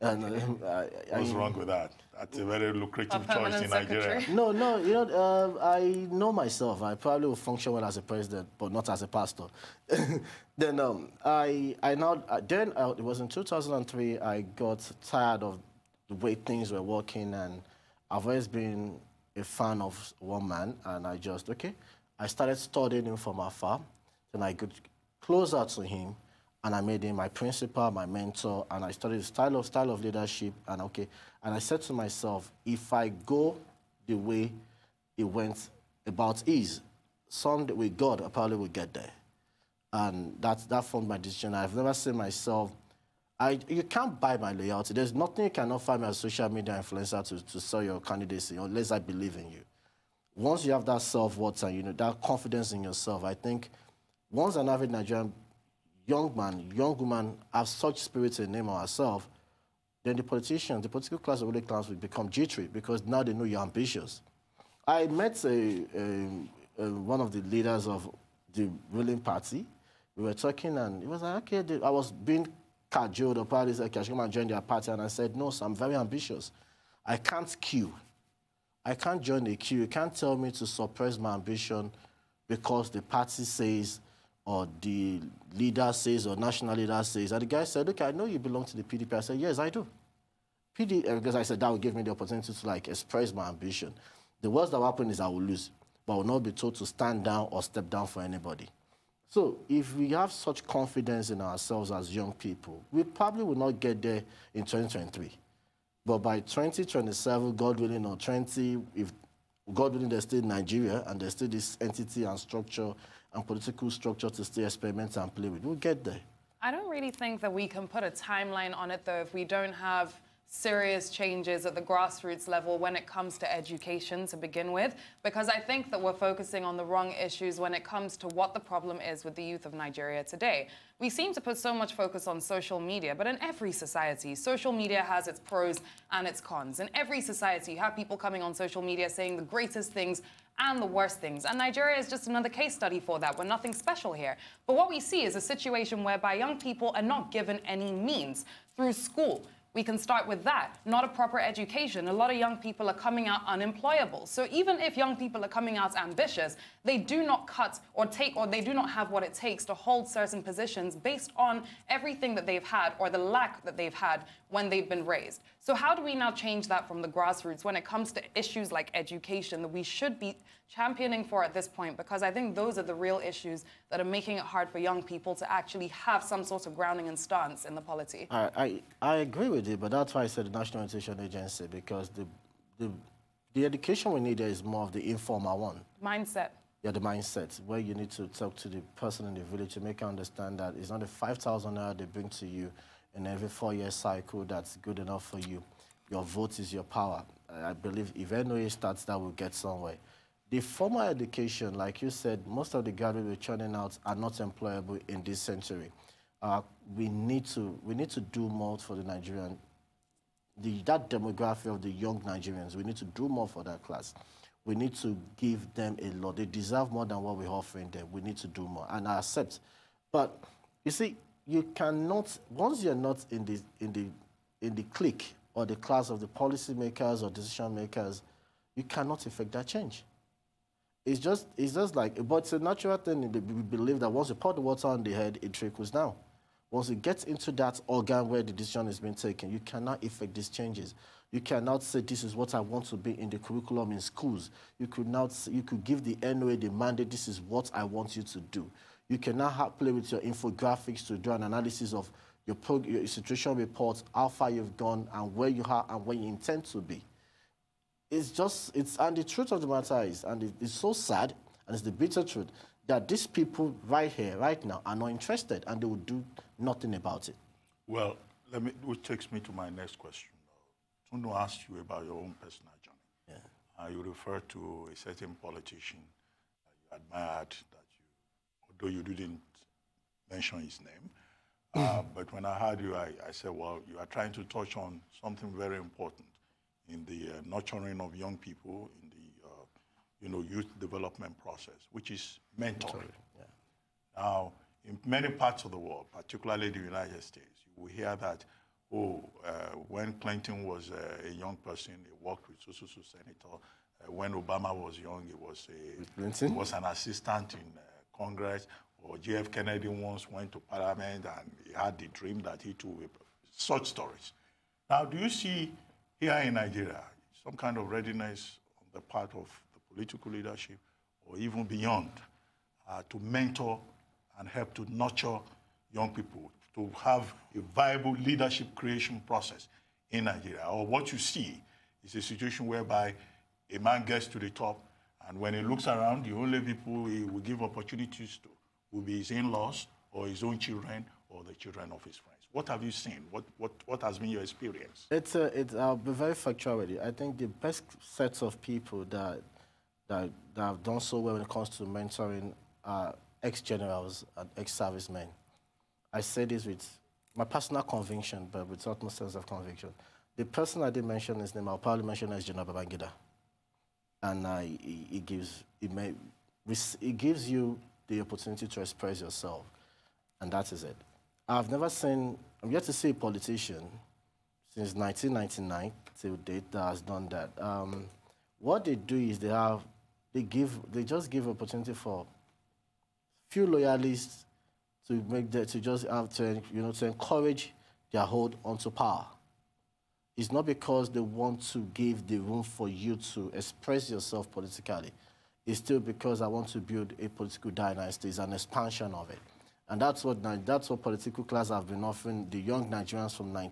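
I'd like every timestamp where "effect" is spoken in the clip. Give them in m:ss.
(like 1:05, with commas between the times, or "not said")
3:49, 4:00.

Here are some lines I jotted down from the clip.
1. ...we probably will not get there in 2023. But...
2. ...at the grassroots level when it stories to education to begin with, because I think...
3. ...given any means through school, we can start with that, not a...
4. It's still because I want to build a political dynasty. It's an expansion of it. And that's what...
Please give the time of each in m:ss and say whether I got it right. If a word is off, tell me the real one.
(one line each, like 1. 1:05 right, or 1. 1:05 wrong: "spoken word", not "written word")
1. 1:42 right
2. 2:01 wrong: "comes", not "stories"
3. 2:27 right
4. 6:35 right.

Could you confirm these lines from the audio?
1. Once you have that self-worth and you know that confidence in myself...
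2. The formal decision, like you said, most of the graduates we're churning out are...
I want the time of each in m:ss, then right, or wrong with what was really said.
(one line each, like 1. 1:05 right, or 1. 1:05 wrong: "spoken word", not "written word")
1. 0:50 wrong: "yourself", not "myself"
2. 3:20 wrong: "education", not "decision".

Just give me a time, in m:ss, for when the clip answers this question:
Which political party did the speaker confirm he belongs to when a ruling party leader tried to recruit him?
1:28.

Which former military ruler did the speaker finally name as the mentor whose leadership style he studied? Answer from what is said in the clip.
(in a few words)
General Babangida.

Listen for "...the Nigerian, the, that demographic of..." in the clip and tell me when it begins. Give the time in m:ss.
3:28.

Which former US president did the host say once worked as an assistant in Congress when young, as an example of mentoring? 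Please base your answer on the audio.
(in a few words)
Obama.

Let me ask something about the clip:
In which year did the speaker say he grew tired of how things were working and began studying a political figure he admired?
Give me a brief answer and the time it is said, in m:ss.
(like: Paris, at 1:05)
2003, at 0:13.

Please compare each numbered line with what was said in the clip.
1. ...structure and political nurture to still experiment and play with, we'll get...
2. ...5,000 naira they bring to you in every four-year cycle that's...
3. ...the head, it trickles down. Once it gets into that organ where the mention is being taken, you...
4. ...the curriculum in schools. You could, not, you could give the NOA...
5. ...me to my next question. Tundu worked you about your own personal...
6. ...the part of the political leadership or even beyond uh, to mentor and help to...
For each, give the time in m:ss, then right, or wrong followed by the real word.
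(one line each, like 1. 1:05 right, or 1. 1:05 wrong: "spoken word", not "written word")
1. 1:52 wrong: "structure", not "nurture"
2. 3:11 right
3. 3:55 wrong: "decision", not "mention"
4. 4:03 right
5. 4:29 wrong: "asked", not "worked"
6. 5:18 right.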